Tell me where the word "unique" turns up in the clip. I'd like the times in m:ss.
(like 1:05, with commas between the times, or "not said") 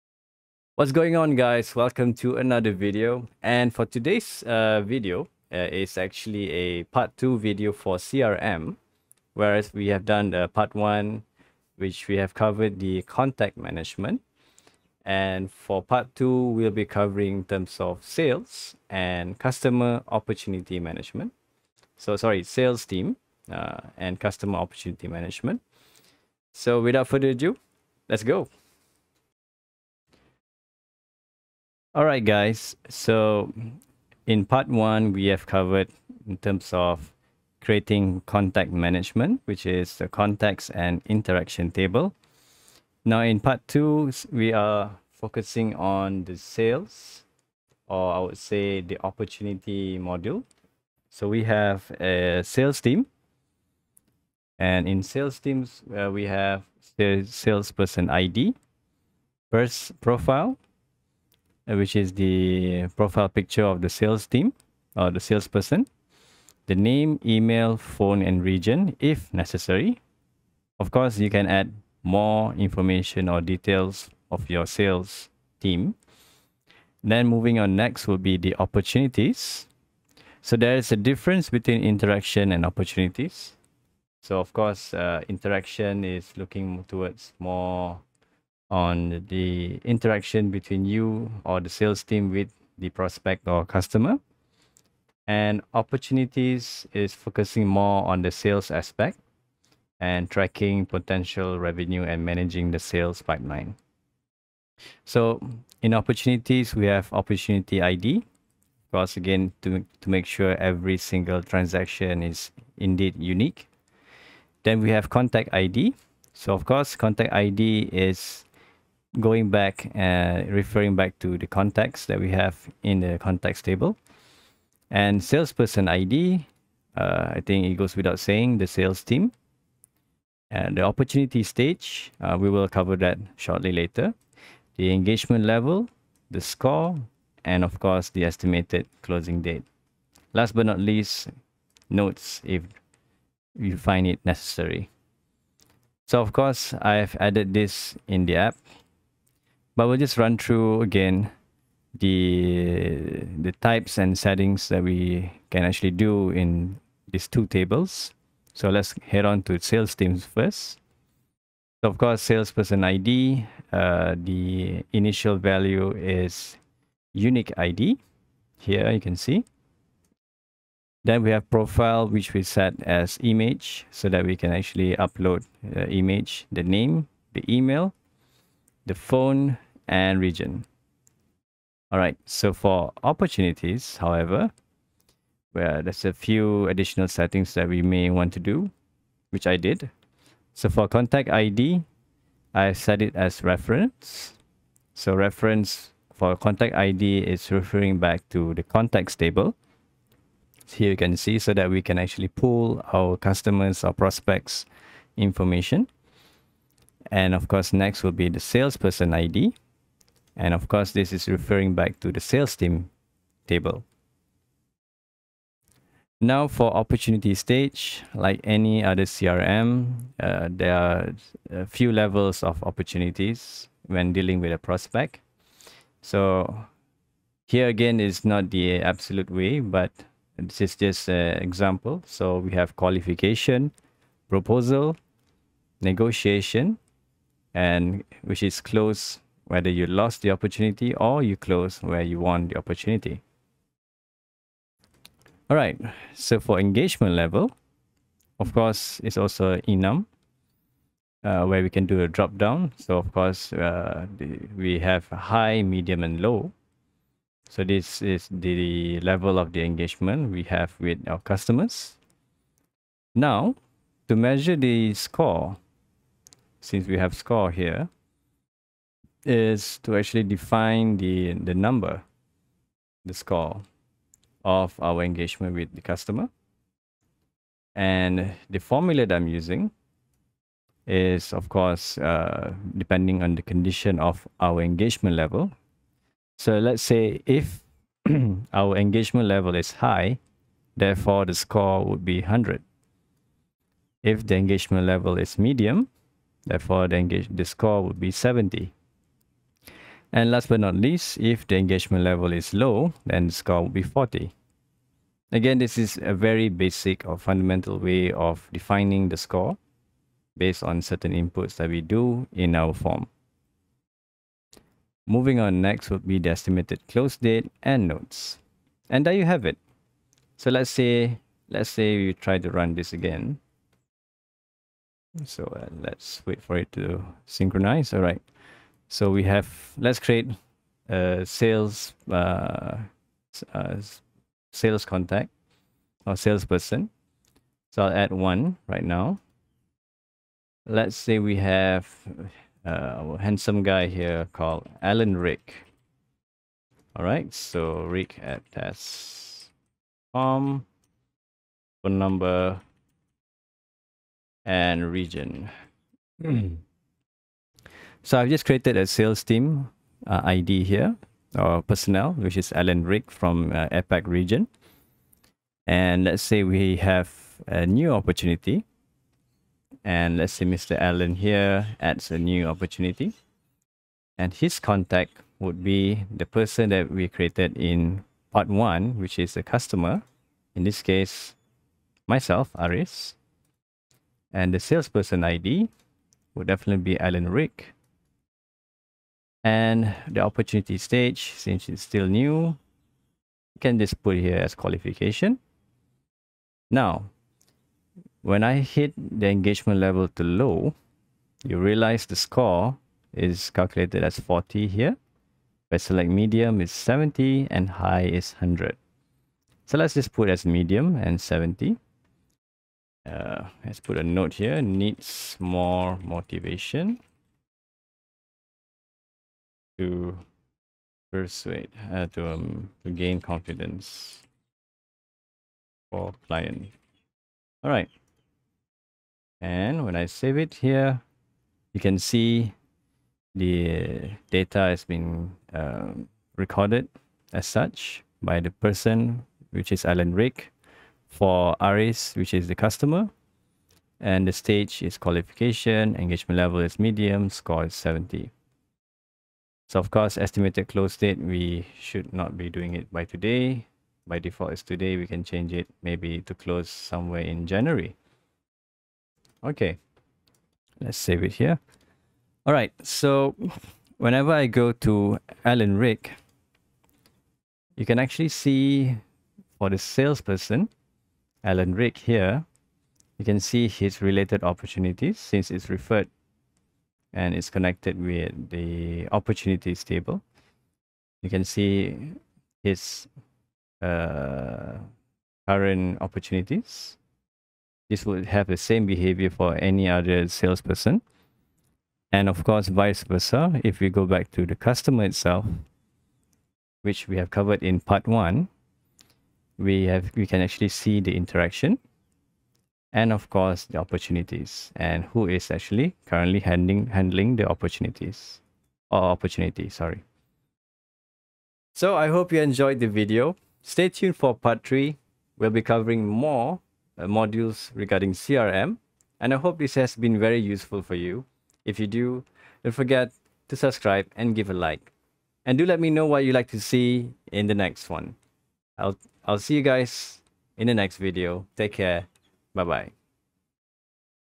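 1:53, 2:47.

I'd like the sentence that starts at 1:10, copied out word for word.
Of course, you can add more information or details of your sales team.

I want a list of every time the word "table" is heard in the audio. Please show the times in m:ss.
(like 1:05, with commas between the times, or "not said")
0:41, 2:03, 2:37, 3:19, 3:33, 7:59.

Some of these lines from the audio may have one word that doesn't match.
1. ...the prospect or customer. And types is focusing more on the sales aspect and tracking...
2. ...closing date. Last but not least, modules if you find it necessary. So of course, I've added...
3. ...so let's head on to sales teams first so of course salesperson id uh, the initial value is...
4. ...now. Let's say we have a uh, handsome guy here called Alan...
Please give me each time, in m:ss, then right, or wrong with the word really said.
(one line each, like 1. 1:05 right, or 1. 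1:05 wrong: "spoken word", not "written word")
1. 1:32 wrong: "opportunities", not "types"
2. 2:19 wrong: "notes", not "modules"
3. 2:38 right
4. 5:38 right.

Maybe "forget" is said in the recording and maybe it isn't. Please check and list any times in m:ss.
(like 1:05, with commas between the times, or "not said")
8:42.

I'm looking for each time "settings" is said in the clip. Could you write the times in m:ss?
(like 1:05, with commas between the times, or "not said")
2:34, 3:07.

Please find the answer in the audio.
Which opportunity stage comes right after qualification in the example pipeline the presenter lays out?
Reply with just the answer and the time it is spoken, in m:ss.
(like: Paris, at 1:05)
proposal, at 3:54.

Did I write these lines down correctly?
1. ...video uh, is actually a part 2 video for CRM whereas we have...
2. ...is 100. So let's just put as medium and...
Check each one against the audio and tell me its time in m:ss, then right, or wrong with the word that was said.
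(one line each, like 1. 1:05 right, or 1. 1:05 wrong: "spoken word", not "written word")
1. 0:04 right
2. 6:48 right.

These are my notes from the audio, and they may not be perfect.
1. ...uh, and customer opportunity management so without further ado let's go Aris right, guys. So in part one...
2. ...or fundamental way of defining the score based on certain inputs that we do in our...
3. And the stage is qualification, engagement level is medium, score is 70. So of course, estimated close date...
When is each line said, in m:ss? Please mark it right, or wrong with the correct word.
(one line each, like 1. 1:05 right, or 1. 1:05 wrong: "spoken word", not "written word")
1. 0:23 wrong: "All", not "Aris"
2. 5:07 right
3. 7:23 right.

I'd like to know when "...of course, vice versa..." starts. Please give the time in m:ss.
8:12.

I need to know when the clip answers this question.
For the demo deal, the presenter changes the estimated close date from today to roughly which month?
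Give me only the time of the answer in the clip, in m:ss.
7:37.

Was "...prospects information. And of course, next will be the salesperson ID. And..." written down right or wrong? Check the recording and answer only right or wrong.
right.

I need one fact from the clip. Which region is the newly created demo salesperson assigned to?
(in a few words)
APAC.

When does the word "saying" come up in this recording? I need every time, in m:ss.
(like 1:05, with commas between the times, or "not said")
2:08.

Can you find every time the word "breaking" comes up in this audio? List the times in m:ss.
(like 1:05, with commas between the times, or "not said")
not said.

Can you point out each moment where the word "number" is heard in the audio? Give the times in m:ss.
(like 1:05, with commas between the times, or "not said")
4:31, 5:51.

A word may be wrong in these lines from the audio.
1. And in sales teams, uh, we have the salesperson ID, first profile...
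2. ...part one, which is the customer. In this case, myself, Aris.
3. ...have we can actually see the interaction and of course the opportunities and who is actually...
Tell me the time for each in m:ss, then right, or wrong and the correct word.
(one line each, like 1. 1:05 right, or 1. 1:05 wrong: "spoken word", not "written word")
1. 0:54 right
2. 6:18 right
3. 8:19 right.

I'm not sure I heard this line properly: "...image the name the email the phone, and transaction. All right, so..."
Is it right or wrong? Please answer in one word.
wrong.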